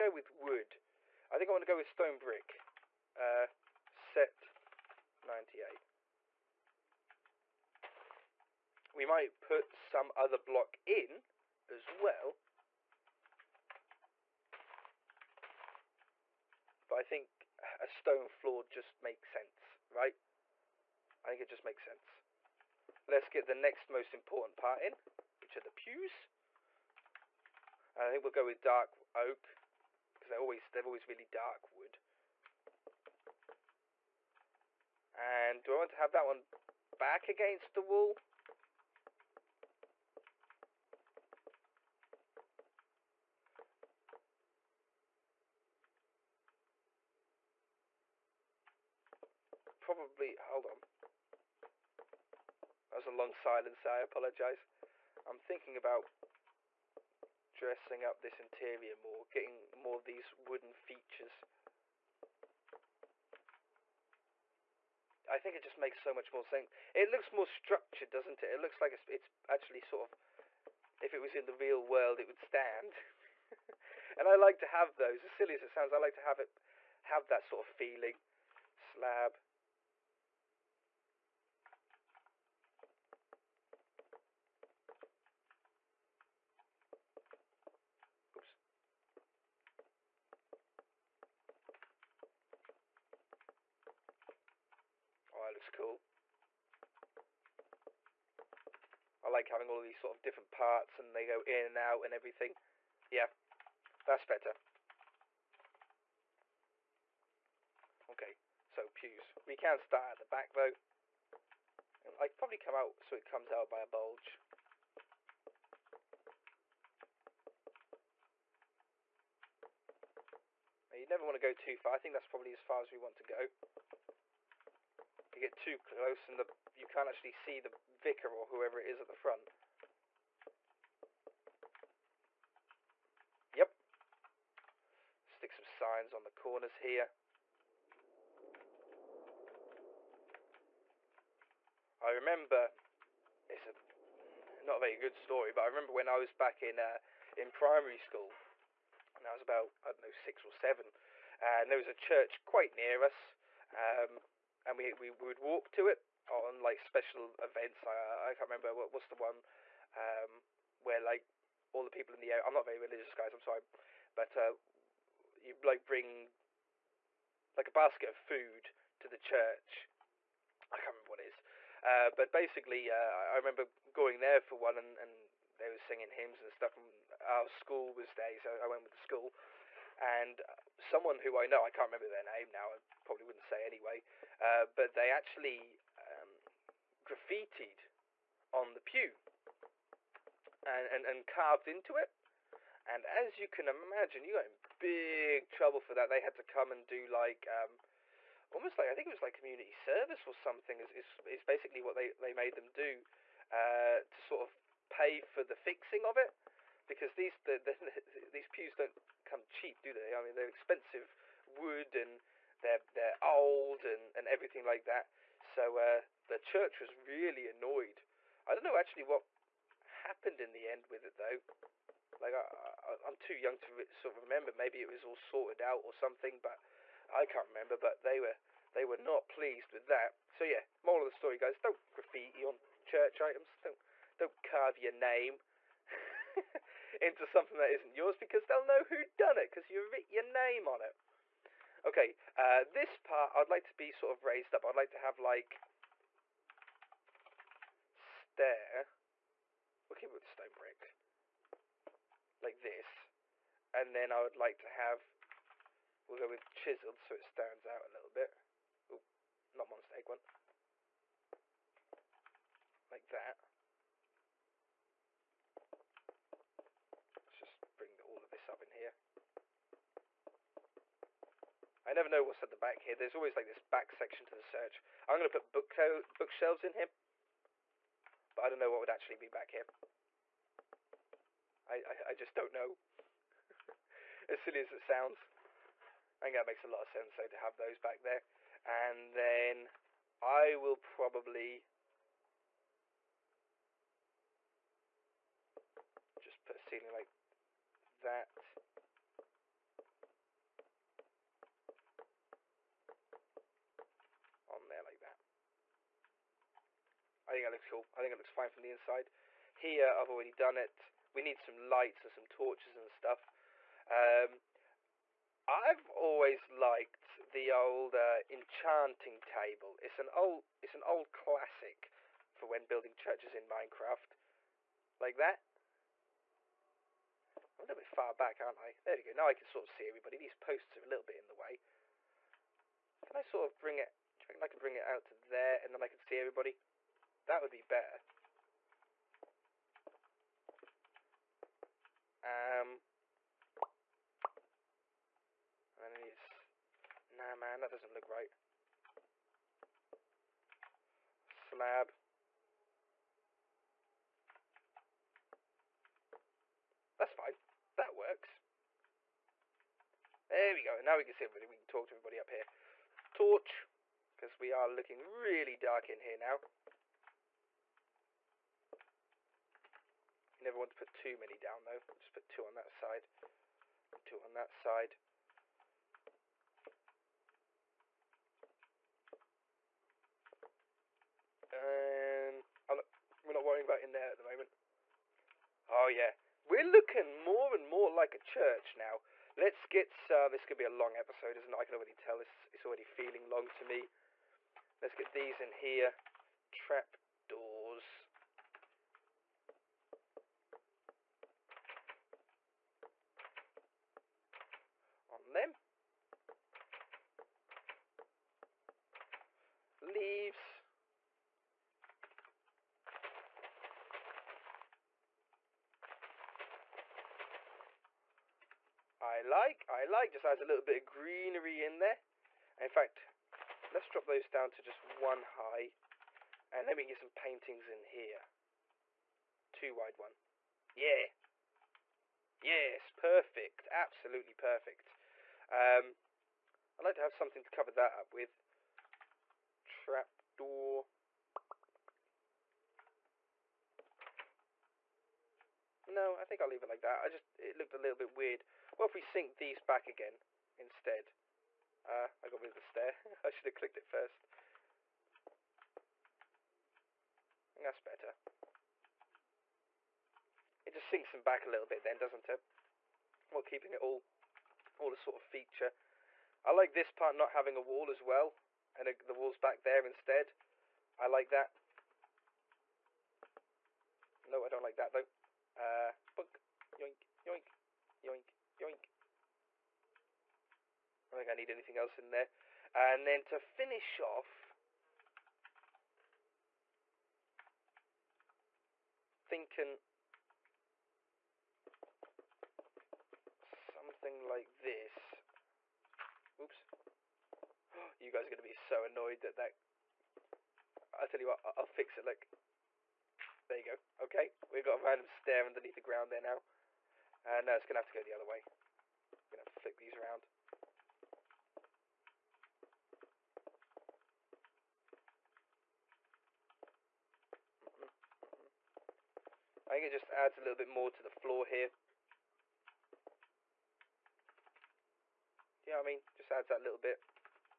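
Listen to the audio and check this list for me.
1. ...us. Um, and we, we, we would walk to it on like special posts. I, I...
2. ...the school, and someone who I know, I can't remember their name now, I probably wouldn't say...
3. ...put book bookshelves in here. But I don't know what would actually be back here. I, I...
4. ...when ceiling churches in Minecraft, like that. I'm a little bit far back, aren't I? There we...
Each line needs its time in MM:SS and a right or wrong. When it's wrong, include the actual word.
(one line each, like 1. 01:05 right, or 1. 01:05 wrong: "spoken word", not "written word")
1. 02:33 wrong: "events", not "posts"
2. 02:58 right
3. 04:35 right
4. 05:22 wrong: "building", not "ceiling".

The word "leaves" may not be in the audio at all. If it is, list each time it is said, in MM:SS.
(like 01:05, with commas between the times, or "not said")
06:49, 07:26.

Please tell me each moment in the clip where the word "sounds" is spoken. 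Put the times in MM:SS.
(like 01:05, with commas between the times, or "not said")
01:15, 04:44.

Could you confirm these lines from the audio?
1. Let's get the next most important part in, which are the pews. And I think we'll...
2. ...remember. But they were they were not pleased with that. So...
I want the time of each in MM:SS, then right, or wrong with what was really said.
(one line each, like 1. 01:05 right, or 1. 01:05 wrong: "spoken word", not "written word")
1. 00:23 right
2. 03:47 right.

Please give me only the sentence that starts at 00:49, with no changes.
Probably, hold on was a long silence I apologise.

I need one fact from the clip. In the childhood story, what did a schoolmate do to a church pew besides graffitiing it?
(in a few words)
Carved into it.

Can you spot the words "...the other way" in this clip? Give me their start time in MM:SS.
08:28.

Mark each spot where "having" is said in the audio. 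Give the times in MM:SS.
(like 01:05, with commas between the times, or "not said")
01:39, 07:47.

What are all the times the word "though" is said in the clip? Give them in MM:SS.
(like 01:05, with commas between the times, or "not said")
01:50, 03:41, 04:47, 06:11, 07:54.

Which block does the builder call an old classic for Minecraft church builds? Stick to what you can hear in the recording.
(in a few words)
Enchanting table.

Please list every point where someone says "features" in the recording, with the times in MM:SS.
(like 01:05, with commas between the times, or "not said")
01:00, 07:45.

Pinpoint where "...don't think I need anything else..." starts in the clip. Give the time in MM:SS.
08:01.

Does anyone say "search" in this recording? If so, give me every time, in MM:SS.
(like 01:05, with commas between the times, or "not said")
04:34.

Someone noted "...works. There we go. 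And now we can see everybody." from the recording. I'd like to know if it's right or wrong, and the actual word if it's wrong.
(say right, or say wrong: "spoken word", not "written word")
right.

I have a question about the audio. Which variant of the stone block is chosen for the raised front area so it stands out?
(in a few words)
Chiseled.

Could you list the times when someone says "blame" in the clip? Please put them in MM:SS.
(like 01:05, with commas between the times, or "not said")
not said.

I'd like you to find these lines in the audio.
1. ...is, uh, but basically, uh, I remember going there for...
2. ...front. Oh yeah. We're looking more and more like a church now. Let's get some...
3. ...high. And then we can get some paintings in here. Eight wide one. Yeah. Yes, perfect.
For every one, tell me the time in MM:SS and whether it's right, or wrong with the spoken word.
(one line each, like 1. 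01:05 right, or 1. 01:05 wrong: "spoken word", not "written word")
1. 02:51 right
2. 06:24 wrong: "moment", not "front"
3. 07:05 wrong: "Two", not "Eight".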